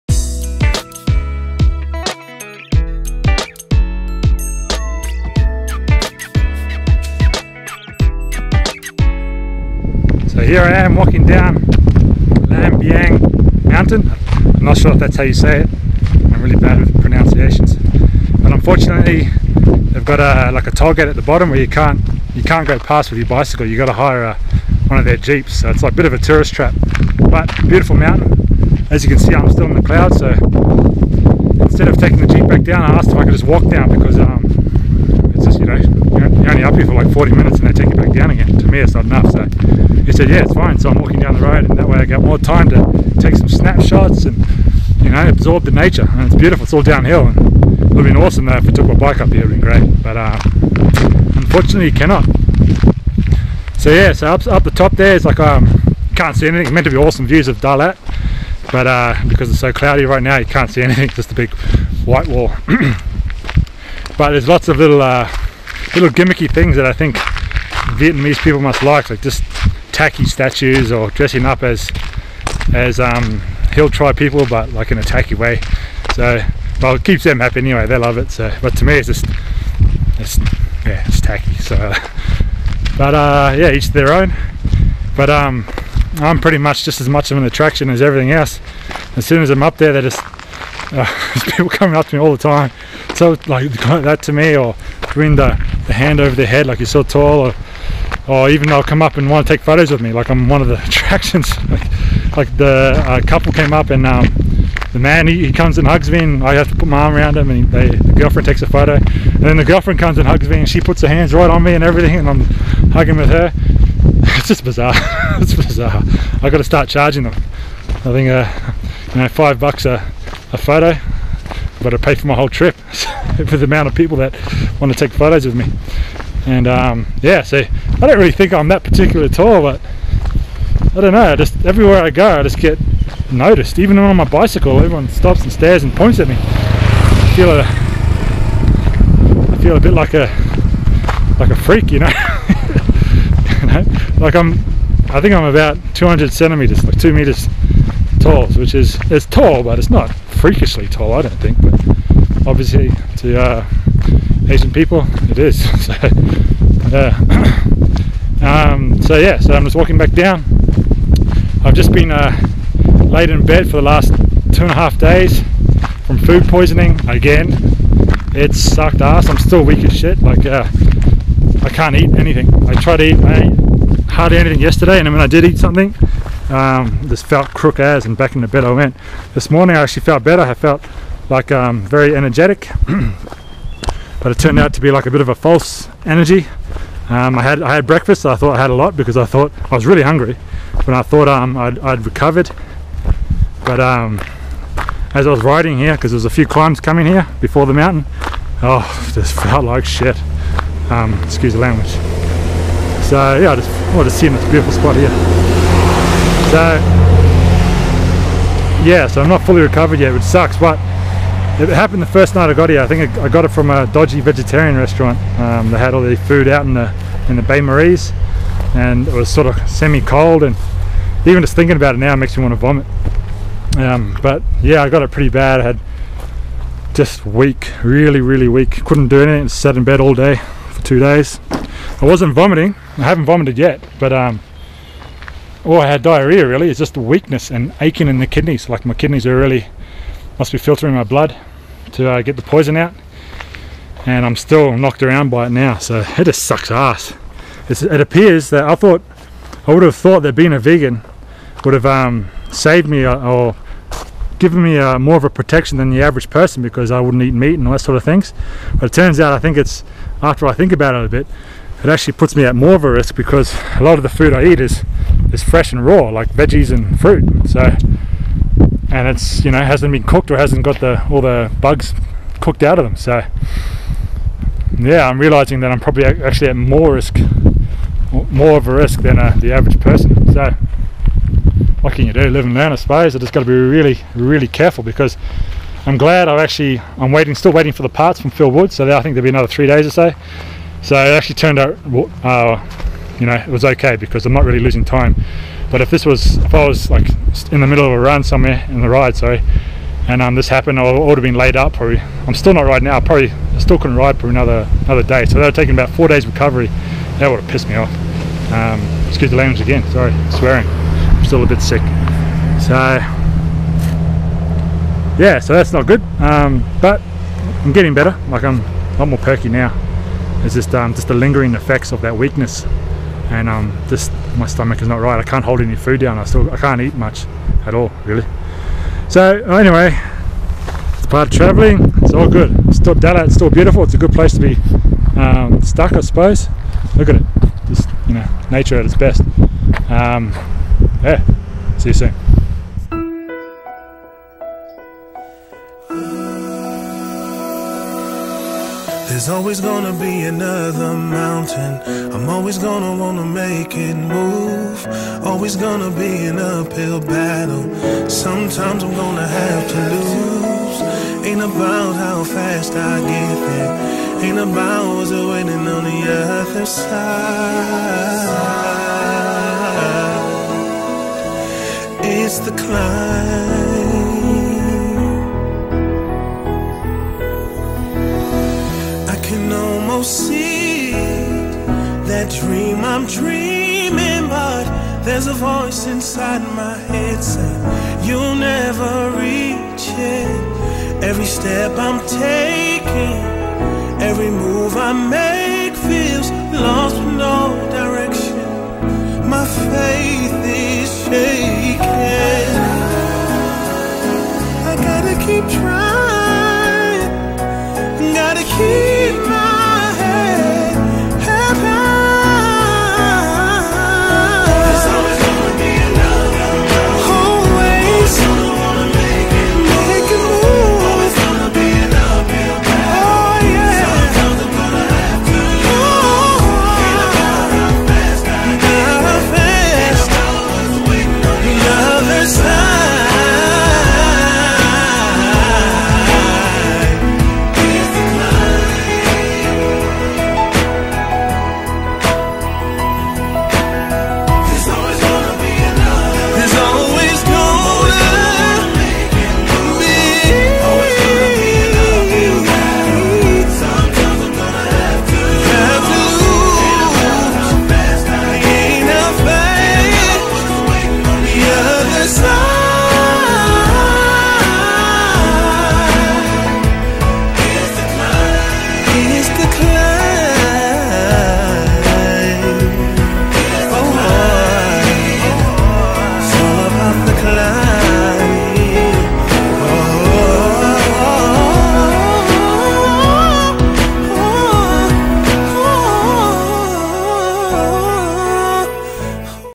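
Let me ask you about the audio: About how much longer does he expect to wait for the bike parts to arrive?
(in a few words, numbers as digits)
3 days.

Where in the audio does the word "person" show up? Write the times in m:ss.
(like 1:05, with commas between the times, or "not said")
4:16, 4:39.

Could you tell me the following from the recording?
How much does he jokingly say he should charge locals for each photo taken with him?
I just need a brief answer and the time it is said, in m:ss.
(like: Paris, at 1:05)
5 bucks, at 1:59.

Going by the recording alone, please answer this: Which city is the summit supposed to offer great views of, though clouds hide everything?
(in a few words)
Dalat.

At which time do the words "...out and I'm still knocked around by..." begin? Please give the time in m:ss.
4:02.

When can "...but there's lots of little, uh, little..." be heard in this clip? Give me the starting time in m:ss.
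1:04.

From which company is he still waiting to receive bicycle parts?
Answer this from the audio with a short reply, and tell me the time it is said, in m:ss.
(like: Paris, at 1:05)
Phil Wood, at 4:48.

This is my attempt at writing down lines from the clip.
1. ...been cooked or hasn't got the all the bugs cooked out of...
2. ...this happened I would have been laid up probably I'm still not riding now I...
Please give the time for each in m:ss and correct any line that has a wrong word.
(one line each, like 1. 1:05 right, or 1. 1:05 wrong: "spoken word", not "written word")
1. 4:29 right
2. 5:00 right.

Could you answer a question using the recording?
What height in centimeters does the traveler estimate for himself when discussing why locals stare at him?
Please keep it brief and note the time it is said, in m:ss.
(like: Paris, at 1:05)
200 centimeters, at 2:25.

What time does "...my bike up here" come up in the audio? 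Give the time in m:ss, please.
0:48.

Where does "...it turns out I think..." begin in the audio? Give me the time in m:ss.
4:18.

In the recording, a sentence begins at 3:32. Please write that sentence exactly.
I think I got it from a dodgy vegetarian restaurant.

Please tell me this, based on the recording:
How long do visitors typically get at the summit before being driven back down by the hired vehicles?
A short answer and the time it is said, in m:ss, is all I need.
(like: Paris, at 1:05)
40 minutes, at 0:37.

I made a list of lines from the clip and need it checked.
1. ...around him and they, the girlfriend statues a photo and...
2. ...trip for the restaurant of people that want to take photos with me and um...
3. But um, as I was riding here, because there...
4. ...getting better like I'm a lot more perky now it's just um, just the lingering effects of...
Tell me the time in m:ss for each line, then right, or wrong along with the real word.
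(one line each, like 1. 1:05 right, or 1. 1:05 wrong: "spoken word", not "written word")
1. 1:47 wrong: "takes", not "statues"
2. 2:02 wrong: "amount", not "restaurant"
3. 3:13 right
4. 5:17 right.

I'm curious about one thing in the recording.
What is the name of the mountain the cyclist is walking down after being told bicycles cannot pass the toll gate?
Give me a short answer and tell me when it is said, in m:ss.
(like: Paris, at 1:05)
Langbiang Mountain, at 0:12.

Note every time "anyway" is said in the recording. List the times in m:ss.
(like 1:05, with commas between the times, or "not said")
1:17, 5:29.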